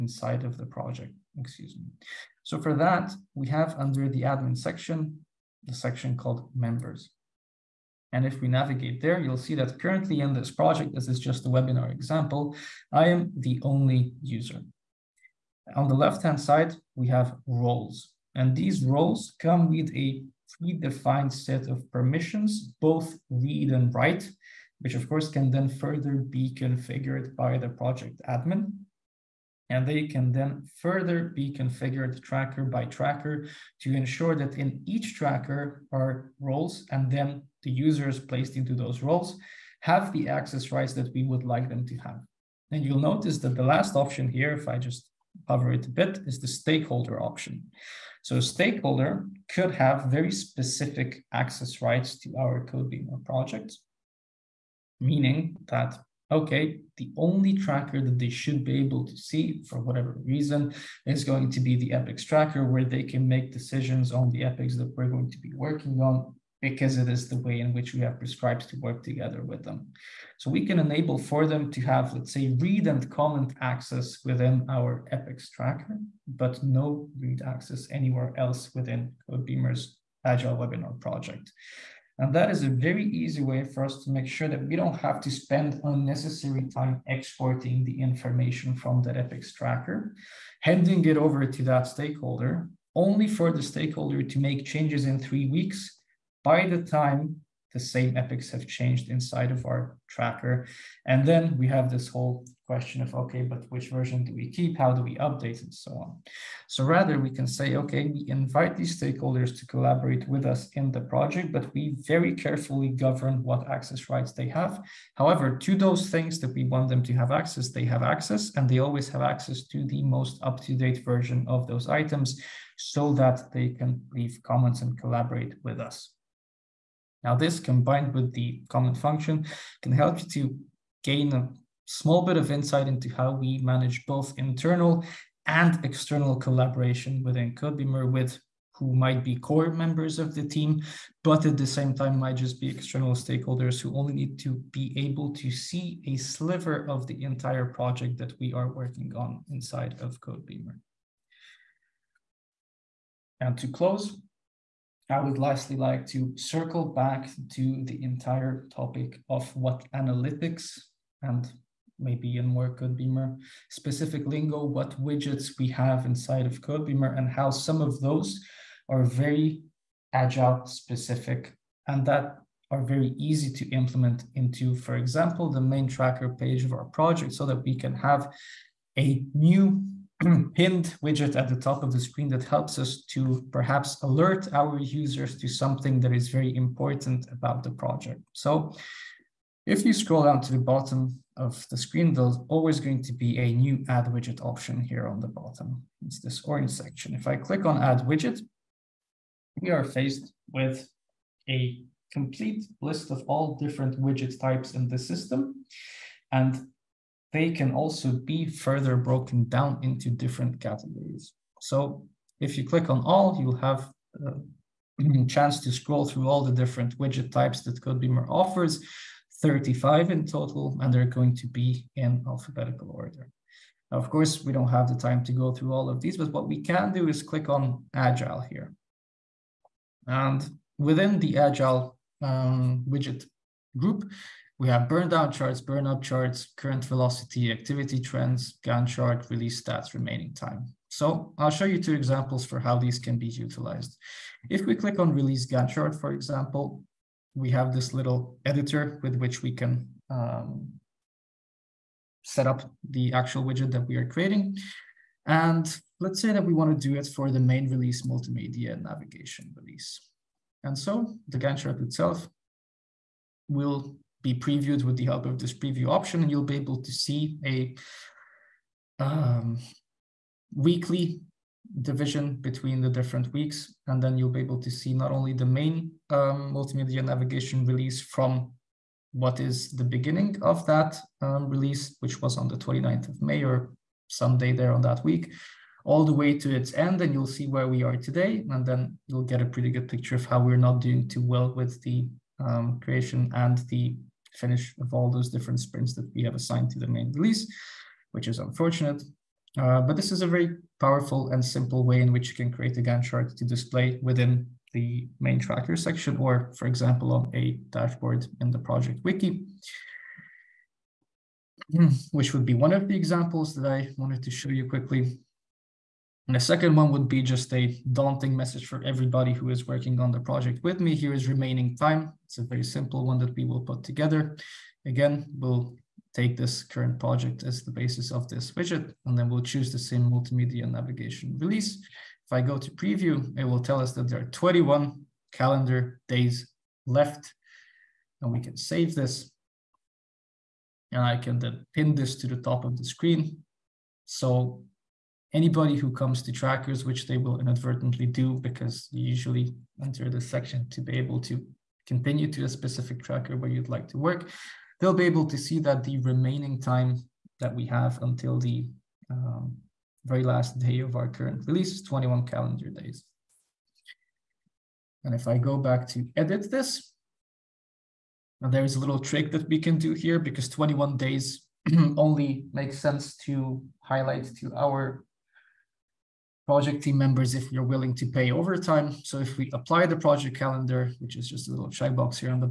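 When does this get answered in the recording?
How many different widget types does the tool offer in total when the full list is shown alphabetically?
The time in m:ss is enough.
3:39.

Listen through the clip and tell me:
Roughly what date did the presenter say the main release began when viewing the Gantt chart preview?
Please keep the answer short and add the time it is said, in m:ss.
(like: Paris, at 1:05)
29th of May, at 4:42.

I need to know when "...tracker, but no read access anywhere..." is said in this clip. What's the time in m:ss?
1:15.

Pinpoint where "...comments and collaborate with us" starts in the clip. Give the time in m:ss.
2:04.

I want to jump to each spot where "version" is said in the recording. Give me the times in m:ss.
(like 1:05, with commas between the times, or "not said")
1:43, 2:01.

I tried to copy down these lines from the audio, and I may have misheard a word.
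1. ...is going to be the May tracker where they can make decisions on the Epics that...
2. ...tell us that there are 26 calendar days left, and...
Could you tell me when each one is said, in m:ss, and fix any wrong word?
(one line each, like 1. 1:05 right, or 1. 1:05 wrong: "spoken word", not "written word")
1. 1:01 wrong: "Epics", not "May"
2. 5:33 wrong: "21", not "26".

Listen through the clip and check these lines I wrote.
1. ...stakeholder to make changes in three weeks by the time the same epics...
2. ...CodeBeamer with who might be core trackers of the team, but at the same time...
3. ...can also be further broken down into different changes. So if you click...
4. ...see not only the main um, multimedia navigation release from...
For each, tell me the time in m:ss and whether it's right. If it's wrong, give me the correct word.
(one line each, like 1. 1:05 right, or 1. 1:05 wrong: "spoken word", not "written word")
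1. 1:33 right
2. 2:17 wrong: "members", not "trackers"
3. 3:27 wrong: "categories", not "changes"
4. 4:34 right.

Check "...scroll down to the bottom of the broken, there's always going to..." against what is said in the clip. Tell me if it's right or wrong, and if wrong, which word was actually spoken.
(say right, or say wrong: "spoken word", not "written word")
wrong: "screen", not "broken".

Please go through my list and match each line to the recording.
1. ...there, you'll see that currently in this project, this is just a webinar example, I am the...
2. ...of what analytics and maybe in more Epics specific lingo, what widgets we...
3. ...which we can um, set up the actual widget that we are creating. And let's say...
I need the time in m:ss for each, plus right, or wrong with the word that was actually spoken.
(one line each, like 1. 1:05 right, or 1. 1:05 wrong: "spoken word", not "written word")
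1. 0:09 right
2. 2:39 wrong: "CodeBeamer", not "Epics"
3. 4:09 right.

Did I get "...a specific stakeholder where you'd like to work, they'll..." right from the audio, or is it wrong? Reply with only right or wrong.
wrong.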